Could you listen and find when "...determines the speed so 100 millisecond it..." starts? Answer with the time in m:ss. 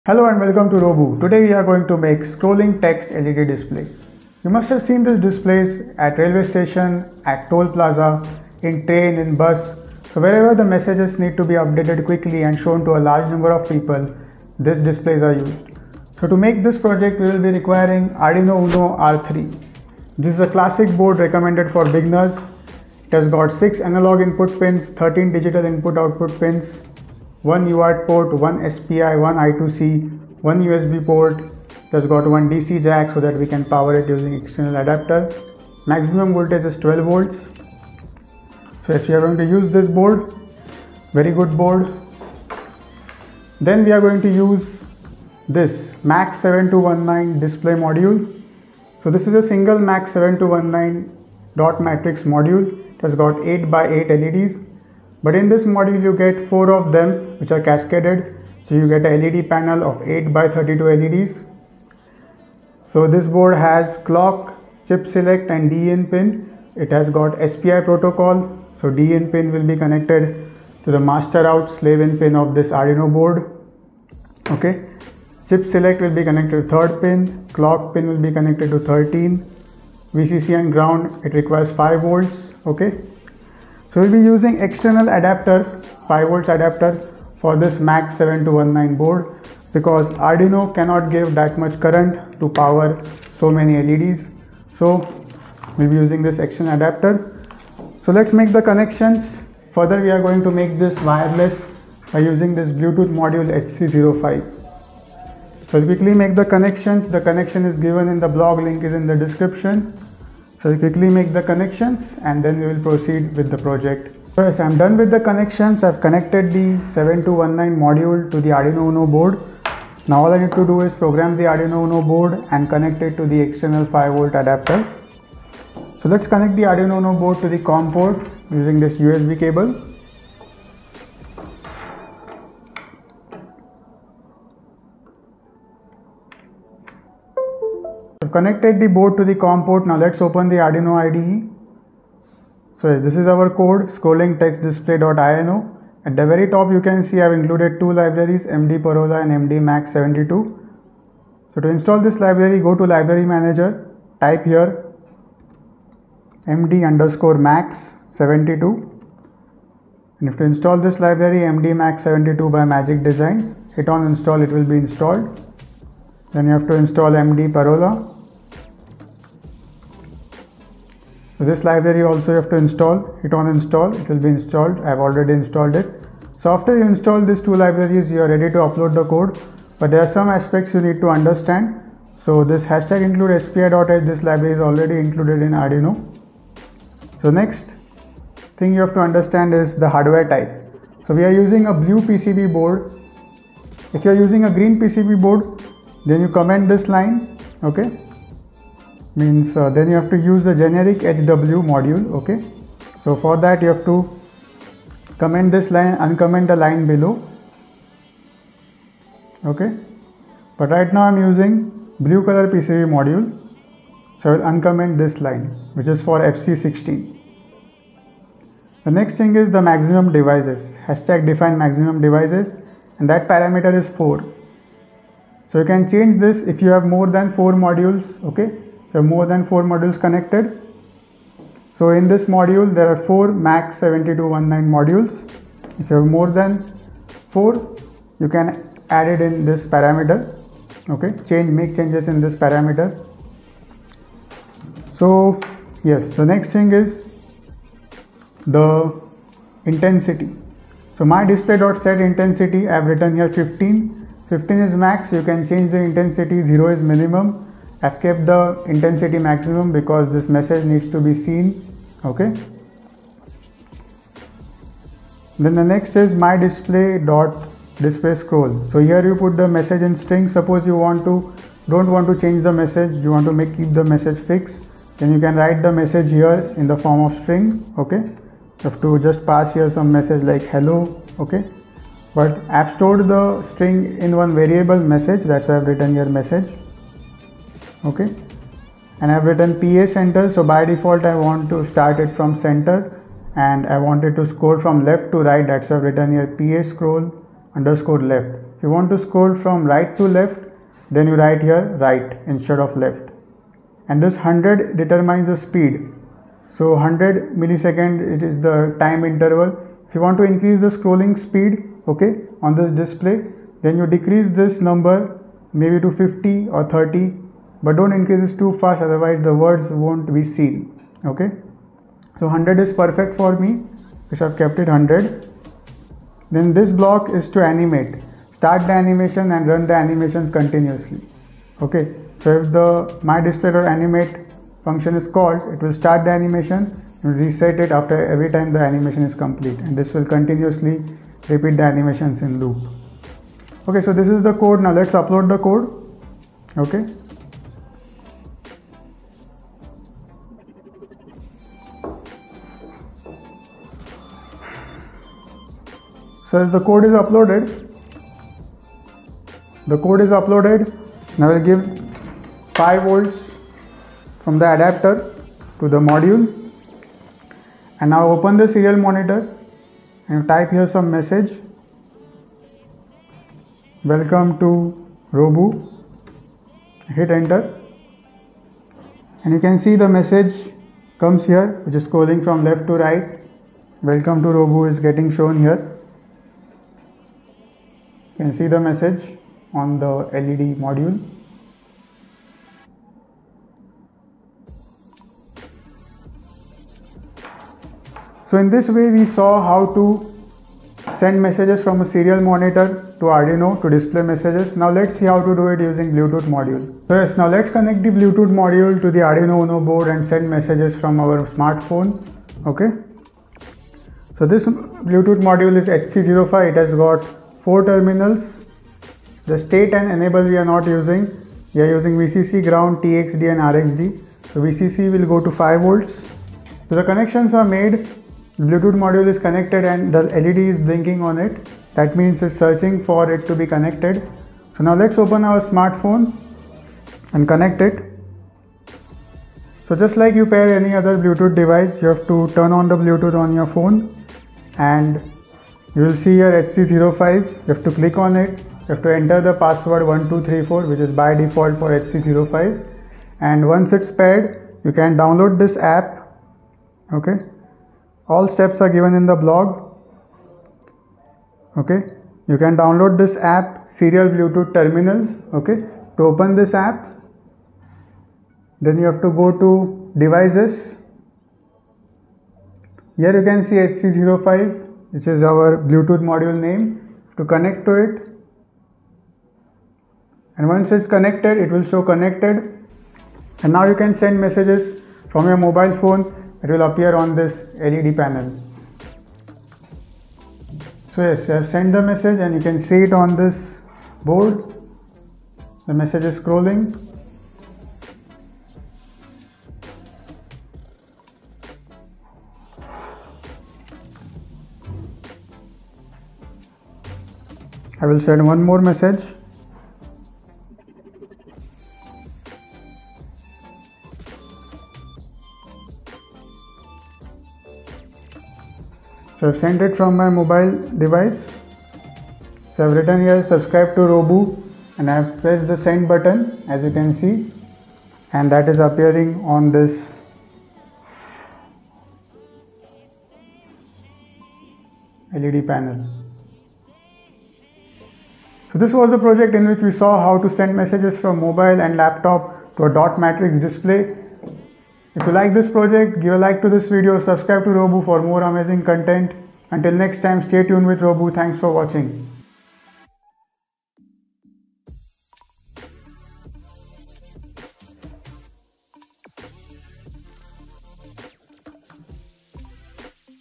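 5:04.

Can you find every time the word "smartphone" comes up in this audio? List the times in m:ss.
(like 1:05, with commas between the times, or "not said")
6:51, 7:15.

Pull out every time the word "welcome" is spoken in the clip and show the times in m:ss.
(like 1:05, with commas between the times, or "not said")
0:00, 6:13, 6:23.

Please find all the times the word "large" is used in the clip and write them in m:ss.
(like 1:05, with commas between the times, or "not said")
0:13.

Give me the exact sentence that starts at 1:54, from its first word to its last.
First, I'm done with the connections.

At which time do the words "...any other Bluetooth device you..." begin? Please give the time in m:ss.
7:20.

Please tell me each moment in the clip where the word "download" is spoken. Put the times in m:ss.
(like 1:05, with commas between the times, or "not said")
7:34, 7:42.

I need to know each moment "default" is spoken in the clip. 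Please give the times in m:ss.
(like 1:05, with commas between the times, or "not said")
4:50, 7:31.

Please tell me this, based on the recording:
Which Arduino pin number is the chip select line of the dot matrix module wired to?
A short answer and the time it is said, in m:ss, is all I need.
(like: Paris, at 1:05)
3, at 1:16.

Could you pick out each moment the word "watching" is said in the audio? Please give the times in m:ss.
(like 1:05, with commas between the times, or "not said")
9:11.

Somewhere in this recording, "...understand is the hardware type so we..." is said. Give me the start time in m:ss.
3:09.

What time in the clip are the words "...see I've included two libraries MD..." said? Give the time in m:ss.
2:27.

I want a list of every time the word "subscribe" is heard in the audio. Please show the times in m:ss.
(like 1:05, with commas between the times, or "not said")
8:43, 9:06.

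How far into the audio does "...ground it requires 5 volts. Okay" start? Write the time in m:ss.
1:20.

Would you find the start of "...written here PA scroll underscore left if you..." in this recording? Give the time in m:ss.
4:55.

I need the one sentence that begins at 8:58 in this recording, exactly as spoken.
So this was a project in which we saw how to send messages from mobile and laptop to a dot matrix display.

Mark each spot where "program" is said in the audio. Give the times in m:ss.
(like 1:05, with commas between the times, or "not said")
2:00.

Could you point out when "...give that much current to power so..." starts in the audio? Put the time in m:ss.
1:31.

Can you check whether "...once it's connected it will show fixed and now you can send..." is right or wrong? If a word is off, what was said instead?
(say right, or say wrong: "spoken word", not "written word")
wrong: "connected", not "fixed".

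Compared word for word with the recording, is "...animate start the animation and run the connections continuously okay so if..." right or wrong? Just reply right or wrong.
wrong.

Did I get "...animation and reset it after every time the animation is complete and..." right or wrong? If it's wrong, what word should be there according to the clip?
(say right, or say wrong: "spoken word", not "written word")
right.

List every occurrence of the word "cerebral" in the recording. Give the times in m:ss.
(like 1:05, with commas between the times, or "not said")
not said.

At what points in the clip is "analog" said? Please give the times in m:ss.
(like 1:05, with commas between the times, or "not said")
0:23.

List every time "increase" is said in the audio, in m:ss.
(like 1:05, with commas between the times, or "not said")
5:10, 5:17.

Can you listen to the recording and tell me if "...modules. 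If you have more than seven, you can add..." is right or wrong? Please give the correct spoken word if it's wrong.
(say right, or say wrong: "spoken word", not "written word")
wrong: "four", not "seven".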